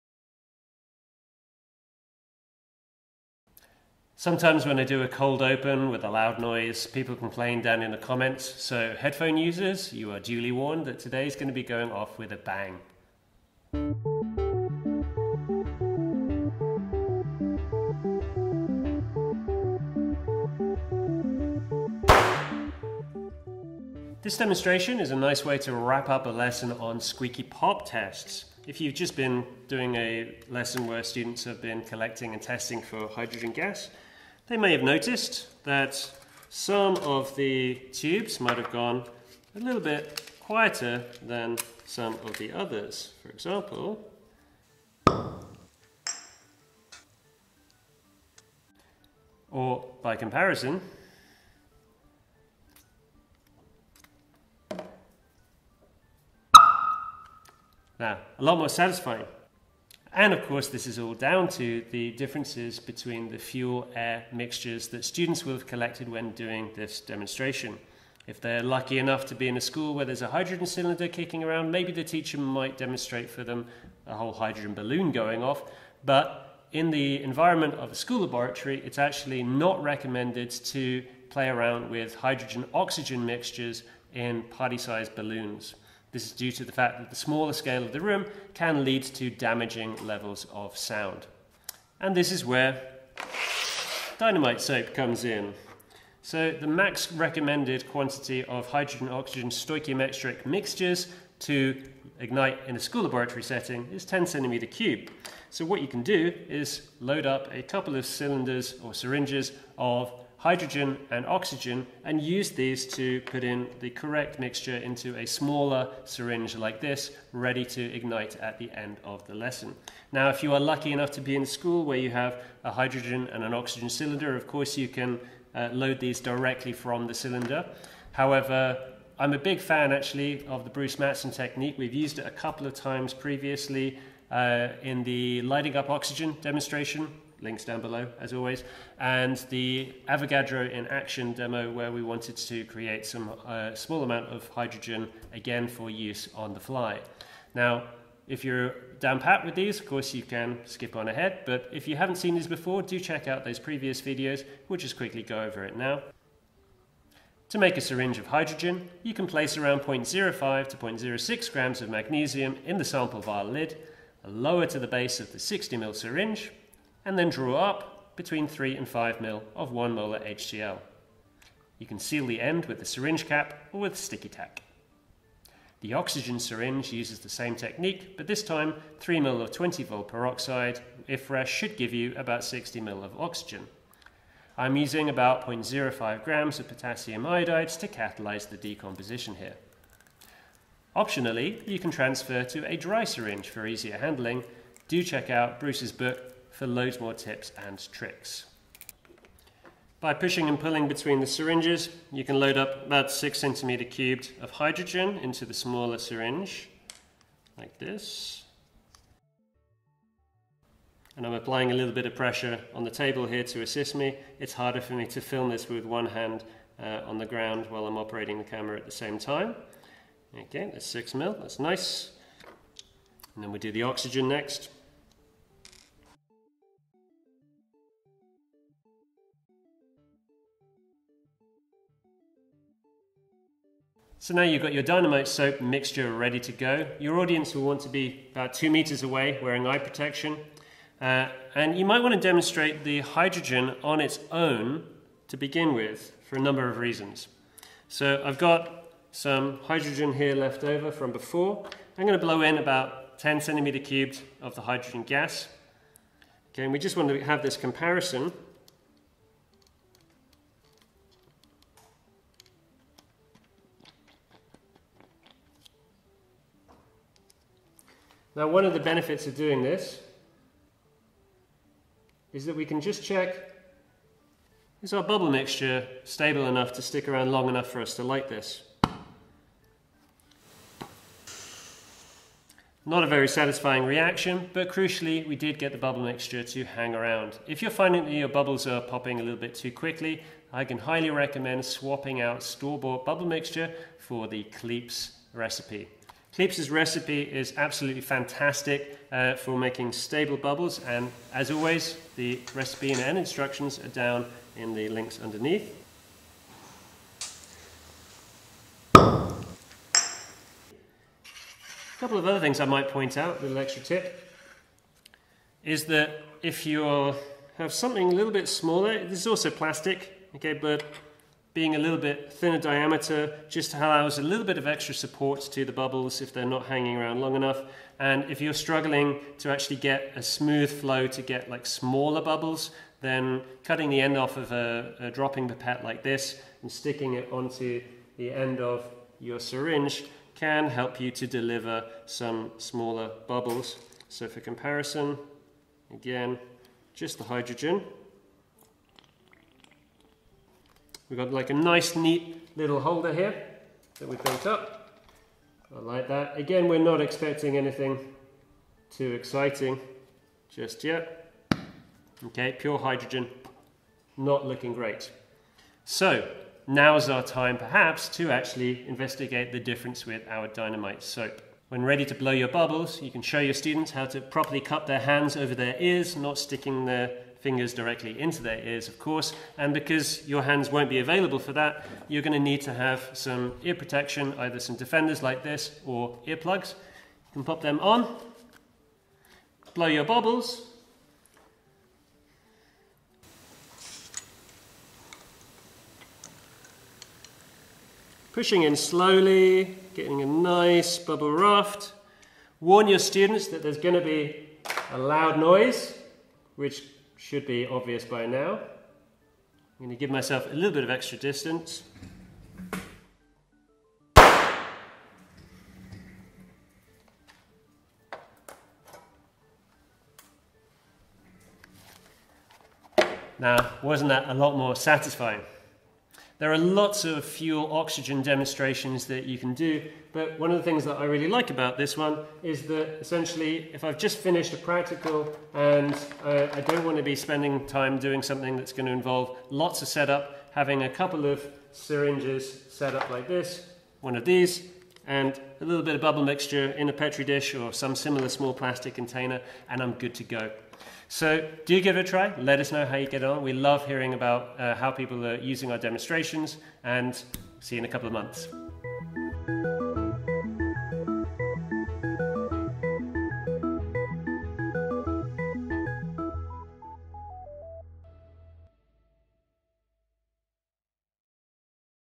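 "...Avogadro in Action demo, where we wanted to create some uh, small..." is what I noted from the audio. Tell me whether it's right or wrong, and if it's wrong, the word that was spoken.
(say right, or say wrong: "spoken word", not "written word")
right.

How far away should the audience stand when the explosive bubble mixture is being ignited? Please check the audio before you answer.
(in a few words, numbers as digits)
2 meters.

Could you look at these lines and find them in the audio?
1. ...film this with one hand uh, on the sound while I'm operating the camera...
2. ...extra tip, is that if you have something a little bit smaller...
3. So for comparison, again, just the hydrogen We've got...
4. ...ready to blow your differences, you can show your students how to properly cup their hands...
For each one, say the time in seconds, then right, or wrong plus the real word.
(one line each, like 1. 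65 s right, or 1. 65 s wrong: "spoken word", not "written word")
1. 215 s wrong: "ground", not "sound"
2. 313 s right
3. 344 s right
4. 371 s wrong: "bubbles", not "differences".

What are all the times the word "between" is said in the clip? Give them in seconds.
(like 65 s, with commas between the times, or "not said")
62 s, 168 s, 200 s.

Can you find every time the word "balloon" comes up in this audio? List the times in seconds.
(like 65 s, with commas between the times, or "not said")
74 s, 85 s.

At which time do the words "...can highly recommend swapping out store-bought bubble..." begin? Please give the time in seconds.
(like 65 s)
290 s.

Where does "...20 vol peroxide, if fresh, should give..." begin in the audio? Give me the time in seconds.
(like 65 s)
179 s.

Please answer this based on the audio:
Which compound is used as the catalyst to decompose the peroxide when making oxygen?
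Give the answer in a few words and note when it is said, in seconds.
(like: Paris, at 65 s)
potassium iodide, at 186 s.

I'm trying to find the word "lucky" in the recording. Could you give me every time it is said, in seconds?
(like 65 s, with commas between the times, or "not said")
68 s, 120 s.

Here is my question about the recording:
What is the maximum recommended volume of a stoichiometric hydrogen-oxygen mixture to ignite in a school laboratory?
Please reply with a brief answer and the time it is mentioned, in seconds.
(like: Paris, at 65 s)
10 cm3, at 104 s.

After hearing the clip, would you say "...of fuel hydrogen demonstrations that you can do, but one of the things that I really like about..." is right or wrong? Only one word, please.
wrong.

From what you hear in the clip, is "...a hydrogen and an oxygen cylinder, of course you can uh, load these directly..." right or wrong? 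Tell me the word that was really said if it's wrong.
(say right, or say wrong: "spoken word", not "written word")
right.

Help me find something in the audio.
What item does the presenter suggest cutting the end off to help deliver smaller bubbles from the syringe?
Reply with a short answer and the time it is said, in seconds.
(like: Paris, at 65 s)
dropping pipette, at 335 s.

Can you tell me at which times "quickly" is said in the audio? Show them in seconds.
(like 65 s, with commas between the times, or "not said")
154 s, 289 s.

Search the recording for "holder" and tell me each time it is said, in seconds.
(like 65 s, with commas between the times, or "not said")
352 s.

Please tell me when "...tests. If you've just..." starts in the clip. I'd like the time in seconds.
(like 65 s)
27 s.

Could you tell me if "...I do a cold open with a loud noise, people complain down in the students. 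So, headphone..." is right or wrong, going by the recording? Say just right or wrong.
wrong.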